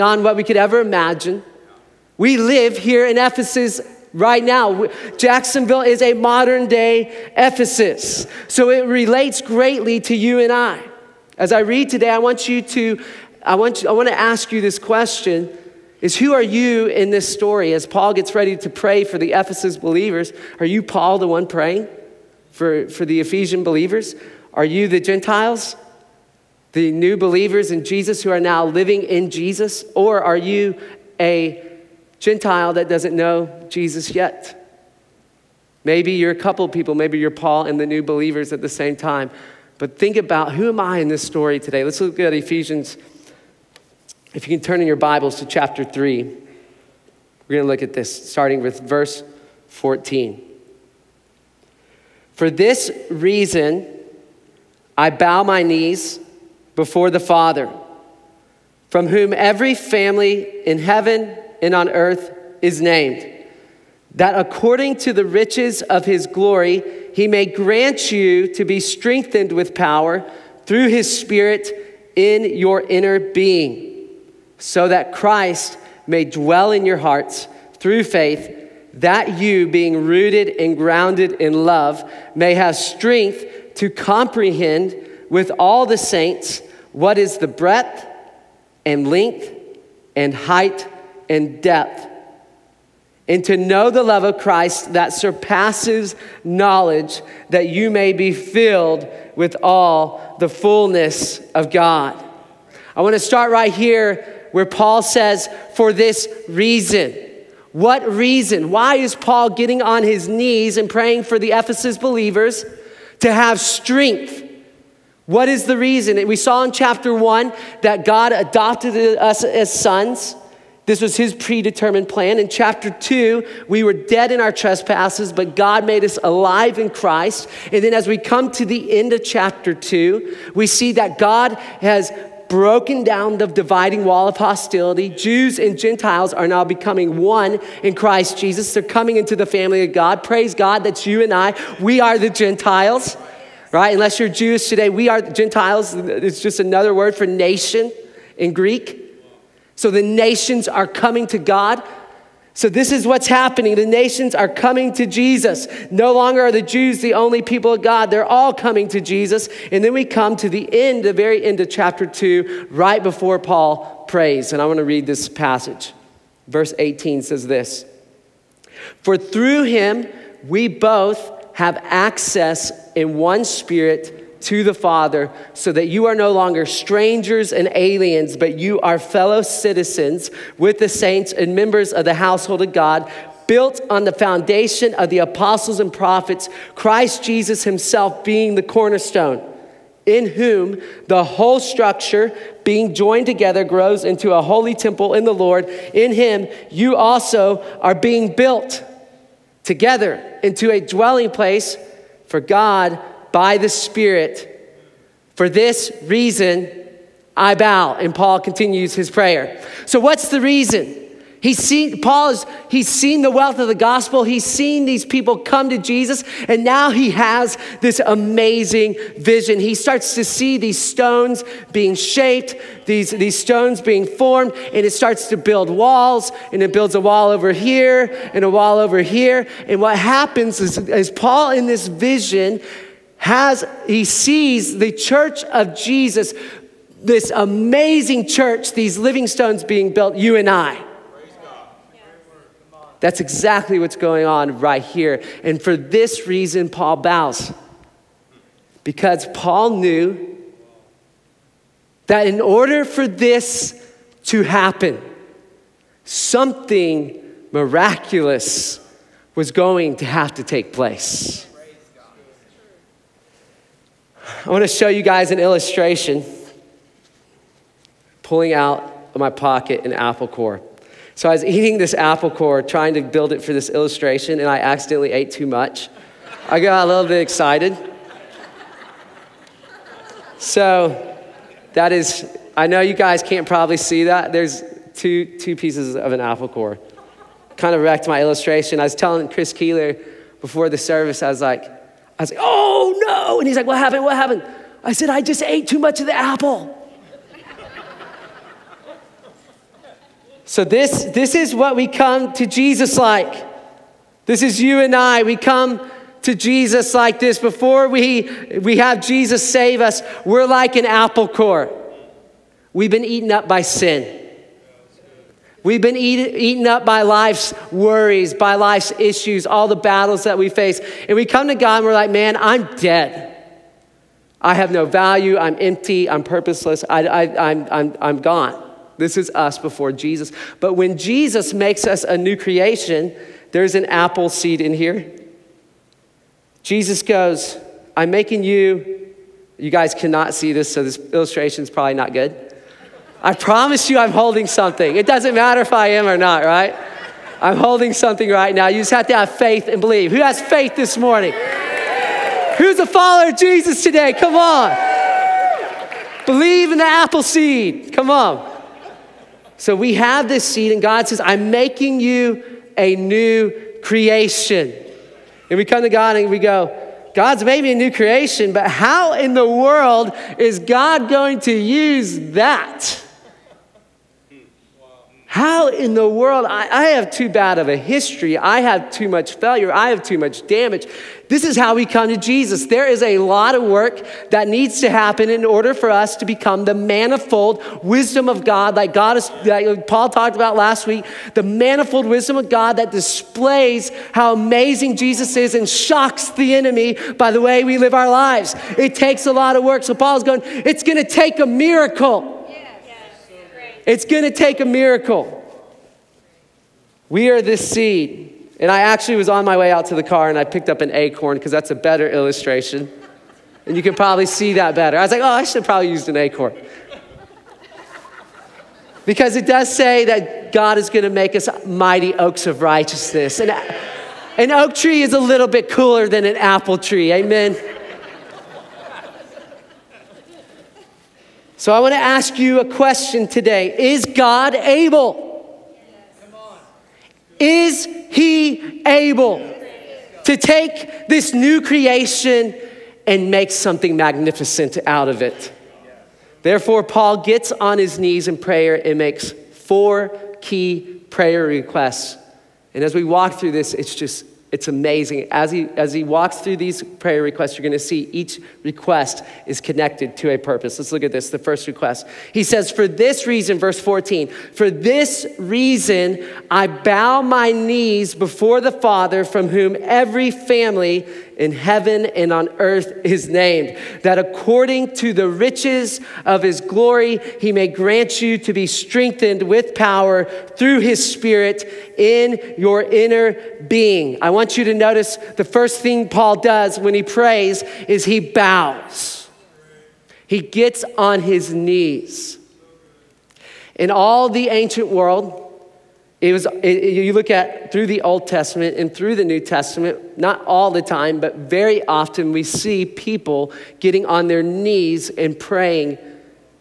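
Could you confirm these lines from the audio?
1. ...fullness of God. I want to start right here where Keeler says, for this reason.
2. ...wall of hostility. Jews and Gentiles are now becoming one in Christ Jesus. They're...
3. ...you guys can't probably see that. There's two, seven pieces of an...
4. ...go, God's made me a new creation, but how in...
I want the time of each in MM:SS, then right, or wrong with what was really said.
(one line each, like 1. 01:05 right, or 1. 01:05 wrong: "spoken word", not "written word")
1. 01:40 wrong: "Paul", not "Keeler"
2. 02:14 right
3. 04:42 wrong: "two", not "seven"
4. 06:06 right.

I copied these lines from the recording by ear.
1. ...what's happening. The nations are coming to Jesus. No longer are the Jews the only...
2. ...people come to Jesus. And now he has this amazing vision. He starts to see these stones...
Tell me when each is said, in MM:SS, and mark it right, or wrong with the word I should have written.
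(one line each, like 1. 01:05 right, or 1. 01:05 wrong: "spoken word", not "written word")
1. 02:33 right
2. 03:35 right.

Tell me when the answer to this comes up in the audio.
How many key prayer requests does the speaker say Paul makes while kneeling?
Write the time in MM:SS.
07:29.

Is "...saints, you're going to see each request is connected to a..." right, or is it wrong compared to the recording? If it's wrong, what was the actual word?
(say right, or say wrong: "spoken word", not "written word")
wrong: "requests", not "saints".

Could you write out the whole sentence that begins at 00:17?
As Paul gets ready to pray for the Ephesus believers, are you Paul, the one praying for, for the Ephesian believers?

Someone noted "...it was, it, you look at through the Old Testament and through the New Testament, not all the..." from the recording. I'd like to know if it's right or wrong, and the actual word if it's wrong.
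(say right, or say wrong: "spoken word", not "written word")
right.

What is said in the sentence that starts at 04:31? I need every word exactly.
So I was eating this apple core, trying to build it for this illustration, and I accidentally ate too much.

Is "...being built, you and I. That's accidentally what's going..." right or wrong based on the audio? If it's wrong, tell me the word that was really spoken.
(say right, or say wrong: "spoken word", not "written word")
wrong: "exactly", not "accidentally".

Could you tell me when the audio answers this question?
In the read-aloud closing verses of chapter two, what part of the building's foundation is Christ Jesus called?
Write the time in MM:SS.
03:08.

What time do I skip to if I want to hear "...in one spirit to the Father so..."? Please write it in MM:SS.
02:52.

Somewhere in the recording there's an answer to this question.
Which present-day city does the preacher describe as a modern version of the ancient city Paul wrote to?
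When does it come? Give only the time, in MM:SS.
00:05.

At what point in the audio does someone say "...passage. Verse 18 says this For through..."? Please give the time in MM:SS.
02:45.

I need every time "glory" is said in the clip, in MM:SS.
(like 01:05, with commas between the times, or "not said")
01:06, 07:56.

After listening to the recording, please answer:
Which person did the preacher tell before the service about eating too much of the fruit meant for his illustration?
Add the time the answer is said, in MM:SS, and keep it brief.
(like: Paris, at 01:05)
Chris Keeler, at 04:49.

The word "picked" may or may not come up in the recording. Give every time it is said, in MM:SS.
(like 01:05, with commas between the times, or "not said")
06:50.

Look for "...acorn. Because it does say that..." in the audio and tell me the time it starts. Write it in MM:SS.
06:56.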